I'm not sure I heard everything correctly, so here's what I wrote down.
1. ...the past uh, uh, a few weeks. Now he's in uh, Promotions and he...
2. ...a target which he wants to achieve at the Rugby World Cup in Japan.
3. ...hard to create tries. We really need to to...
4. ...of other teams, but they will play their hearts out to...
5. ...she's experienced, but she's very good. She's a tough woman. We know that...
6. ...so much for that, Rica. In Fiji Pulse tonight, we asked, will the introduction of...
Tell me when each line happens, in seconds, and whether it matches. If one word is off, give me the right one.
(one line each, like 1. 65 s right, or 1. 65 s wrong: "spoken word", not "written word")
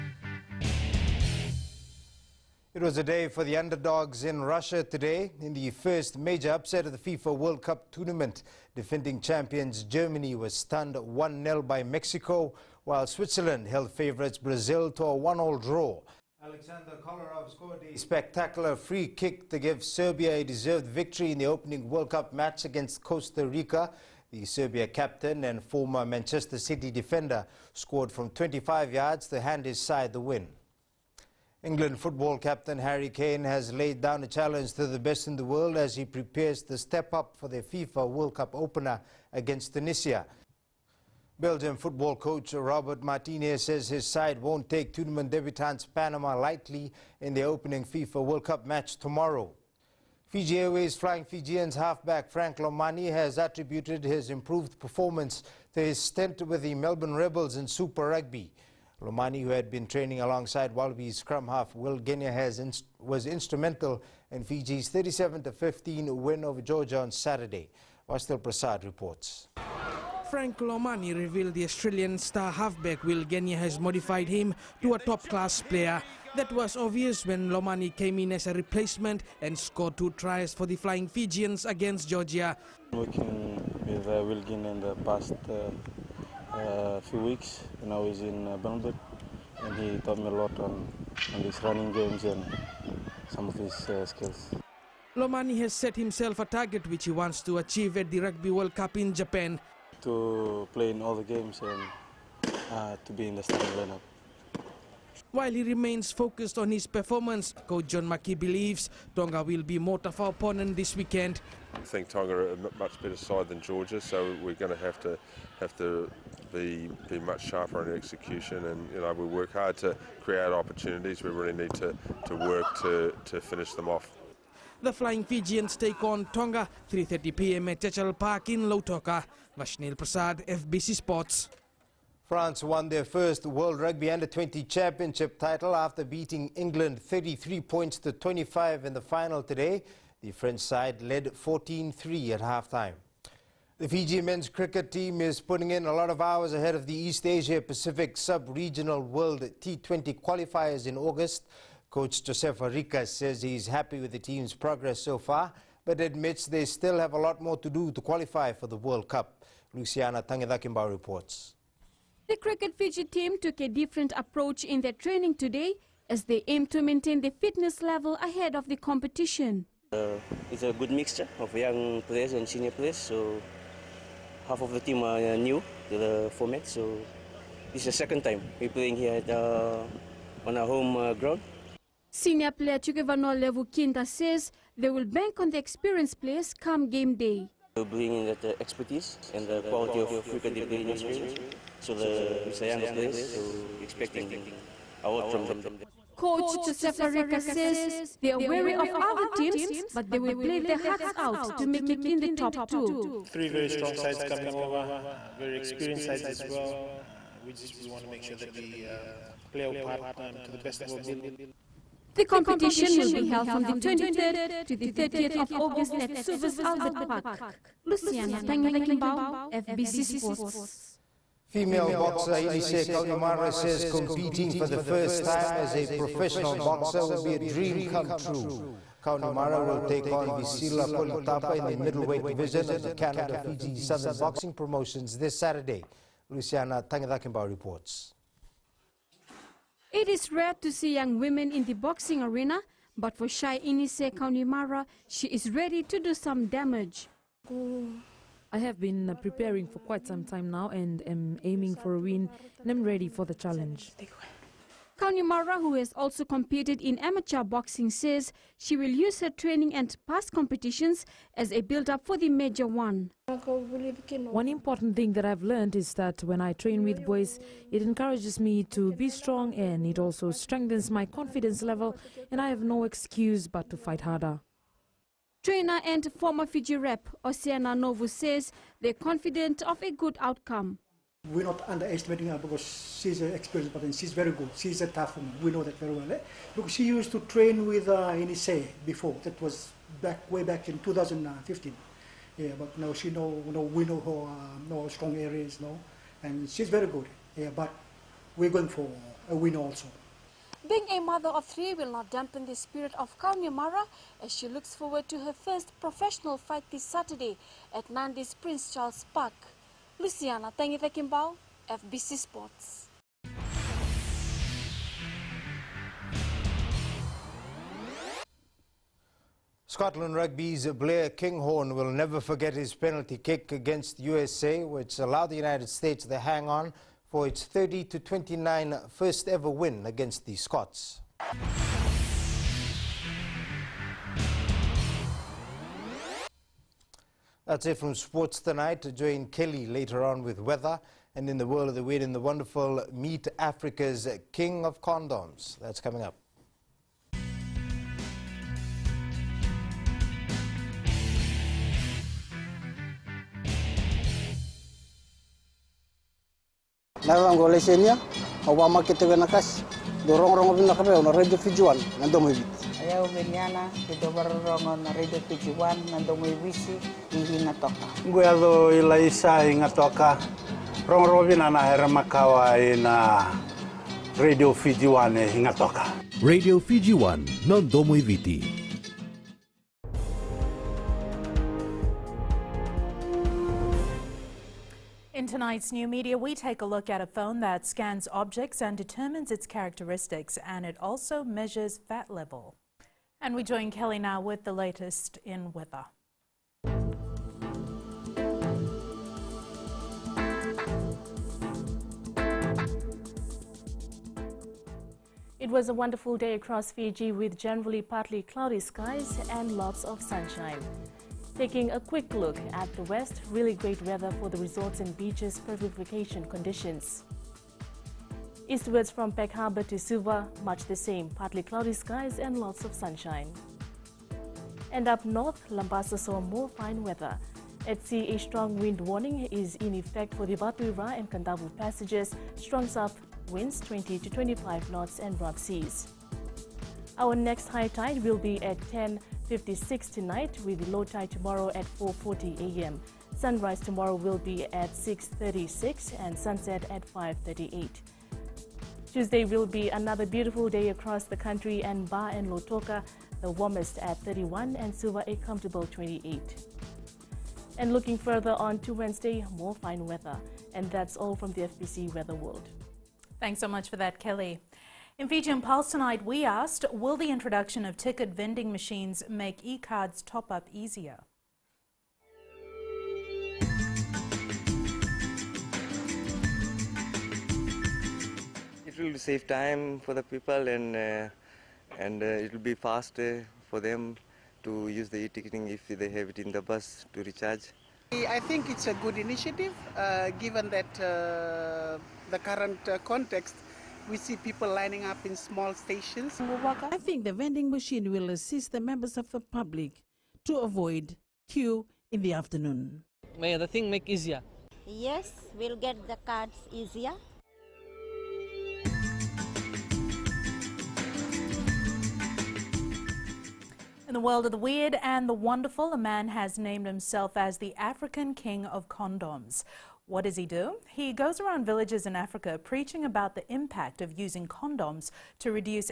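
1. 84 s wrong: "Bernburg", not "Promotions"
2. 96 s right
3. 119 s wrong: "opportunities", not "tries"
4. 198 s right
5. 283 s right
6. 463 s wrong: "Kelly", not "Rica".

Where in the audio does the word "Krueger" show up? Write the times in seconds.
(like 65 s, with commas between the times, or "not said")
not said.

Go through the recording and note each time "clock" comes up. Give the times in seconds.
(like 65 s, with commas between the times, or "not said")
not said.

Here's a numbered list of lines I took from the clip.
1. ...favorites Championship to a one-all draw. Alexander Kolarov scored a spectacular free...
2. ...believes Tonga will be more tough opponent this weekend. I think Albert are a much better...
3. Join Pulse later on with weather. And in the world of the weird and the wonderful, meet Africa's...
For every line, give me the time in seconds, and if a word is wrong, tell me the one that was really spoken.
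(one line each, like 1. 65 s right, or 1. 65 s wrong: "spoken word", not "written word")
1. 13 s wrong: "Brazil", not "Championship"
2. 108 s wrong: "Tonga", not "Albert"
3. 338 s wrong: "Kelly", not "Pulse".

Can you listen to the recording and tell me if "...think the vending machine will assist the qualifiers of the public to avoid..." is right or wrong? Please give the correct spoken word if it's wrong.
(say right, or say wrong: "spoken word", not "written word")
wrong: "members", not "qualifiers".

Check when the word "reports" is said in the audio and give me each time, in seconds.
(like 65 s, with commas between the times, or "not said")
68 s, 160 s, 237 s.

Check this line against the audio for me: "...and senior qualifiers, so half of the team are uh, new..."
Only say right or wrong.
wrong.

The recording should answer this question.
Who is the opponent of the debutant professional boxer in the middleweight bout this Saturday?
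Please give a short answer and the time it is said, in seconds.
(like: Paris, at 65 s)
Visila Kolitapa, at 230 s.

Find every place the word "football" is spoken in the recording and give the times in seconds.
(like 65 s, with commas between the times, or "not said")
31 s, 41 s.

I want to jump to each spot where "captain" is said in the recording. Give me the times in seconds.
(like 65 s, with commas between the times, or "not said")
24 s, 32 s.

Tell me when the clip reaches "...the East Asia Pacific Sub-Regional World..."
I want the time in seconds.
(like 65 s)
146 s.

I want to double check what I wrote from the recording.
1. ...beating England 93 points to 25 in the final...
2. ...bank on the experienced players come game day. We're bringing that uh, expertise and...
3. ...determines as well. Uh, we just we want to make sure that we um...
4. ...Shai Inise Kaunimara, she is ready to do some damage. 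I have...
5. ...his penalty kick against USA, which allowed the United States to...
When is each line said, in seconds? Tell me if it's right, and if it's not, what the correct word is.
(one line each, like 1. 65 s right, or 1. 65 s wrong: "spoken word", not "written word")
1. 136 s wrong: "33", not "93"
2. 185 s right
3. 206 s wrong: "sides", not "determines"
4. 243 s right
5. 322 s right.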